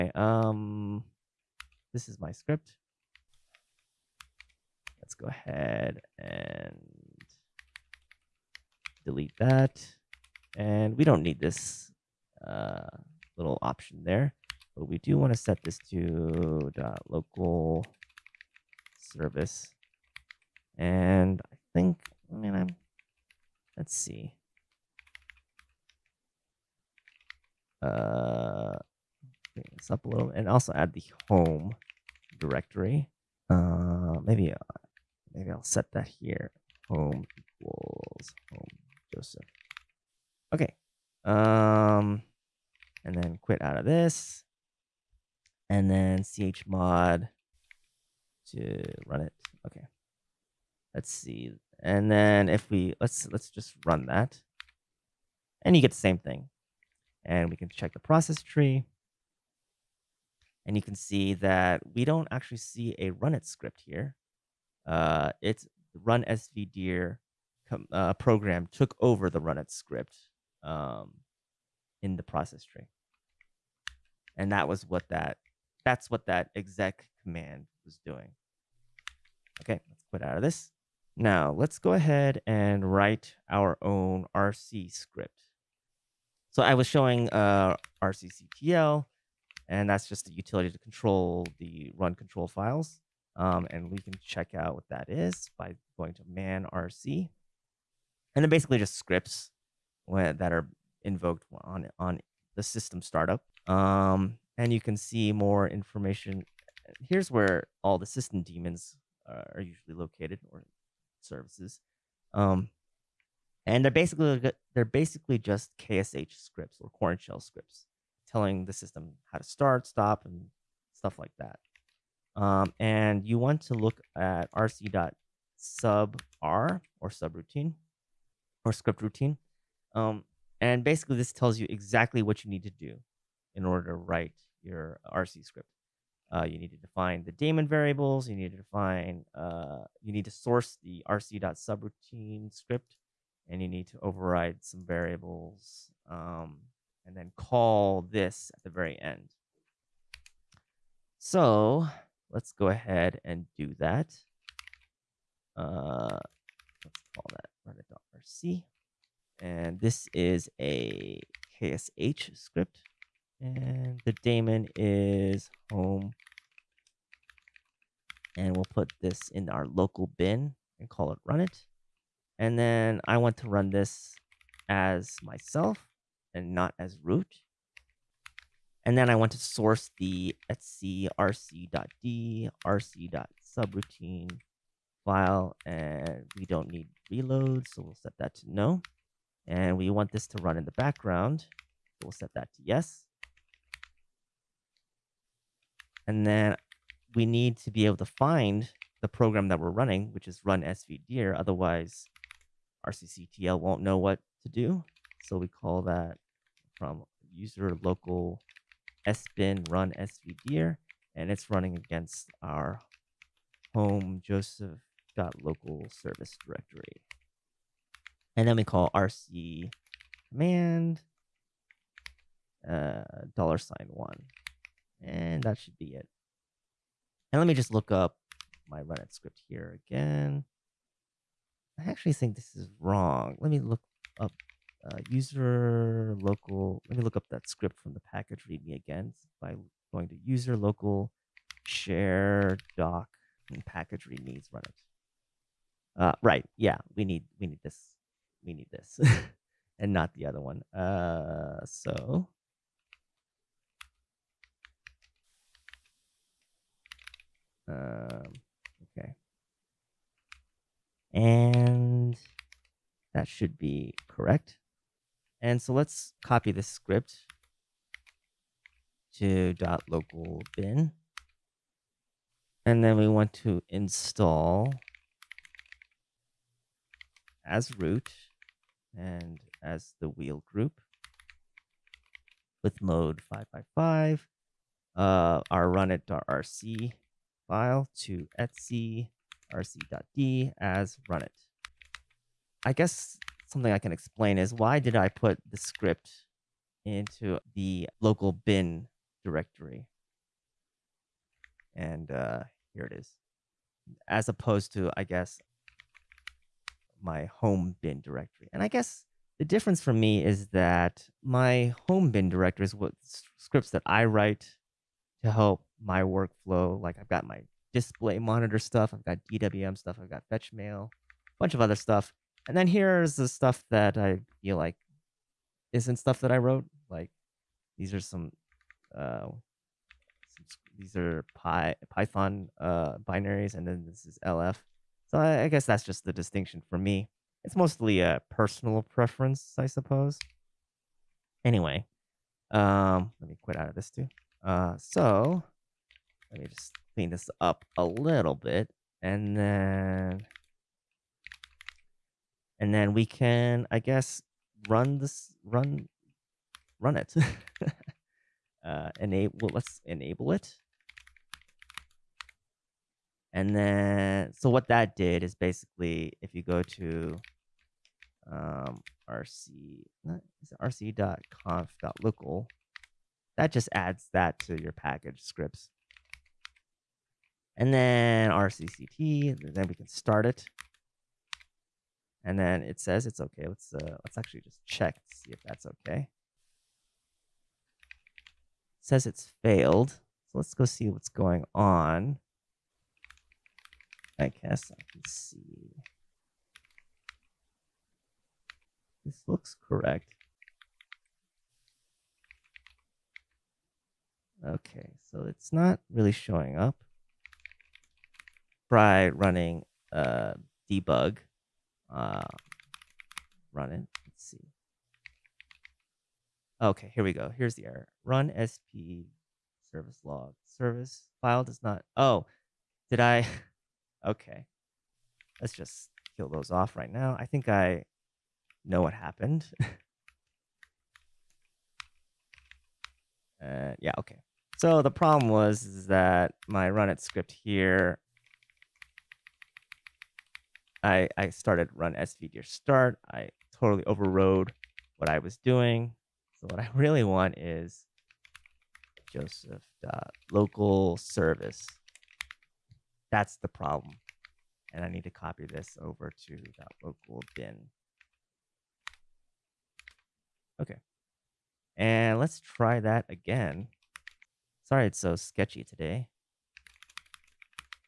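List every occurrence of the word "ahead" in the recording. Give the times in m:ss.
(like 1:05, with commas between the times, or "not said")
0:05, 1:21, 2:32.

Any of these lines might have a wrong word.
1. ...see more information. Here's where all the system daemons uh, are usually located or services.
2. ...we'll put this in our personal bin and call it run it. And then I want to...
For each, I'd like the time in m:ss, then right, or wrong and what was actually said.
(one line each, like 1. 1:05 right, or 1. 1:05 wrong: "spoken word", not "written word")
1. 1:44 right
2. 2:48 wrong: "local", not "personal".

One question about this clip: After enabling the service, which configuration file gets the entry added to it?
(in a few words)
rc.conf.local.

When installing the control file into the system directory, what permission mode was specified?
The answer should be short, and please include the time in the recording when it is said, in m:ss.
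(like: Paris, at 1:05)
555, at 4:42.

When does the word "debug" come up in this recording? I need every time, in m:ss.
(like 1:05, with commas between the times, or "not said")
6:50.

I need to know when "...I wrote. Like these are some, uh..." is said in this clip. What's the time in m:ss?
5:26.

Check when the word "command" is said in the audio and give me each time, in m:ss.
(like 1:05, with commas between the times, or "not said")
1:17, 3:40.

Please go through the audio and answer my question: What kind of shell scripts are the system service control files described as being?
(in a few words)
Korn shell scripts.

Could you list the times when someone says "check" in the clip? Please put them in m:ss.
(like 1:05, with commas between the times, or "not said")
0:57, 1:34, 6:24.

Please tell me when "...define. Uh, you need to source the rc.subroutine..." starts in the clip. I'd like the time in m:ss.
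2:18.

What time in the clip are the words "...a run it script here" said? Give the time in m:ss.
1:02.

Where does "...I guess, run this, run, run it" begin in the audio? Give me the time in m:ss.
5:53.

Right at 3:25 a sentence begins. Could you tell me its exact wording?
So we call that from user local sbin run svdir, and it's running against our home joseph.local service directory.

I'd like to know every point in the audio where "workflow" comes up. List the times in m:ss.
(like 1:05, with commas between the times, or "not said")
5:16.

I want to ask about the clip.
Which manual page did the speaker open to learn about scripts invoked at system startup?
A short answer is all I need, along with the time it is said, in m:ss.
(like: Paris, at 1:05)
man rc, at 1:36.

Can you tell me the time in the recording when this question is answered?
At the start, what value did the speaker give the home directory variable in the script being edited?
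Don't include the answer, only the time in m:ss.
0:36.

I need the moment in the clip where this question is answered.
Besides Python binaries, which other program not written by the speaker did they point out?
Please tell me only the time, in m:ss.
5:33.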